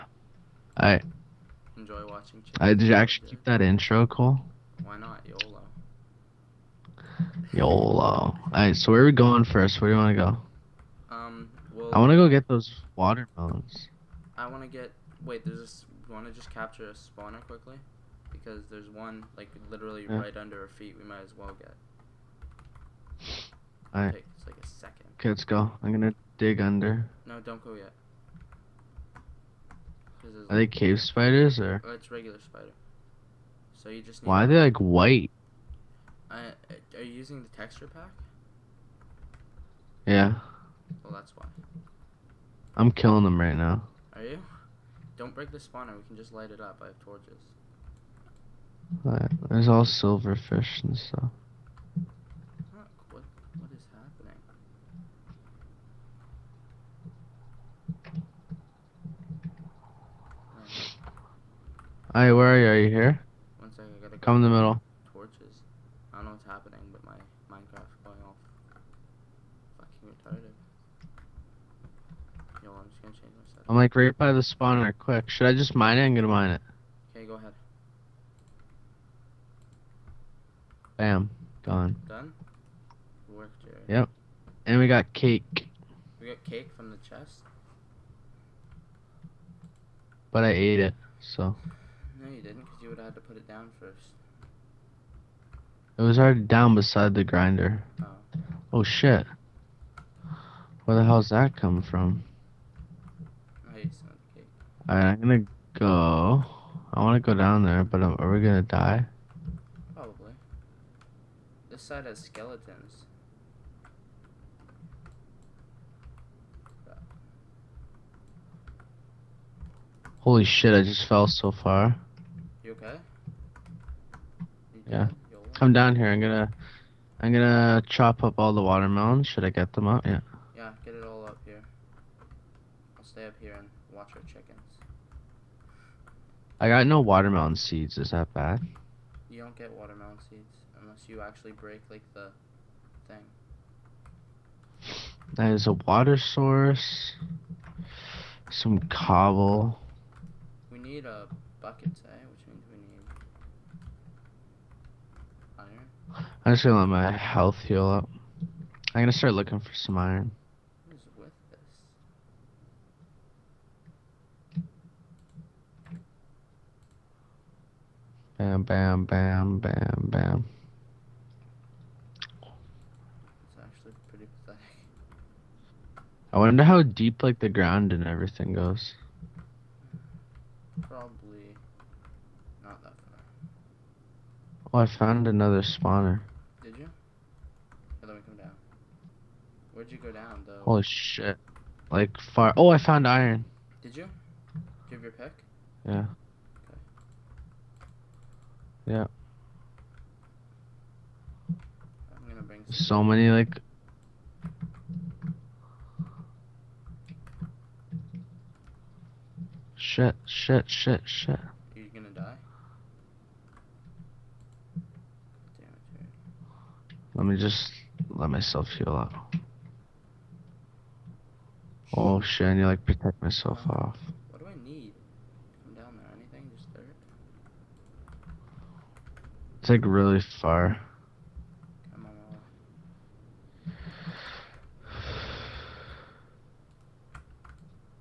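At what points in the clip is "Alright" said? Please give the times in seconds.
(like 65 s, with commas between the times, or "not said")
0 s, 8 s, 23 s, 49 s, 103 s.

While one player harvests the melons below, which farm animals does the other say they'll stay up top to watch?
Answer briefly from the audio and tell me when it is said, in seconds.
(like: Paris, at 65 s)
Chickens, at 134 s.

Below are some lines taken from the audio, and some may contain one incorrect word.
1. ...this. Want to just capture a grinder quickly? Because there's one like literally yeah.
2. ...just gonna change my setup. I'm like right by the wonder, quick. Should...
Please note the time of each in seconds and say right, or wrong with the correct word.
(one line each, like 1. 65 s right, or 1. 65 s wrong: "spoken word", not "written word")
1. 15 s wrong: "spawner", not "grinder"
2. 72 s wrong: "spawner", not "wonder".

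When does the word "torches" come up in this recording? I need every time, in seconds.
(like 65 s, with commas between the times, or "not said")
47 s, 65 s.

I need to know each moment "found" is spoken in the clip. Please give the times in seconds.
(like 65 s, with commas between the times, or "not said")
184 s, 192 s.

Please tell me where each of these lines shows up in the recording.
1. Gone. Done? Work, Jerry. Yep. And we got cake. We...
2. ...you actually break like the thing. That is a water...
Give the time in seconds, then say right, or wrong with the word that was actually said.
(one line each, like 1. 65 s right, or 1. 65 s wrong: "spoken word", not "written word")
1. 81 s right
2. 141 s right.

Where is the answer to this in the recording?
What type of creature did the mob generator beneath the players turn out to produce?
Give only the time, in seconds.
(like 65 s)
32 s.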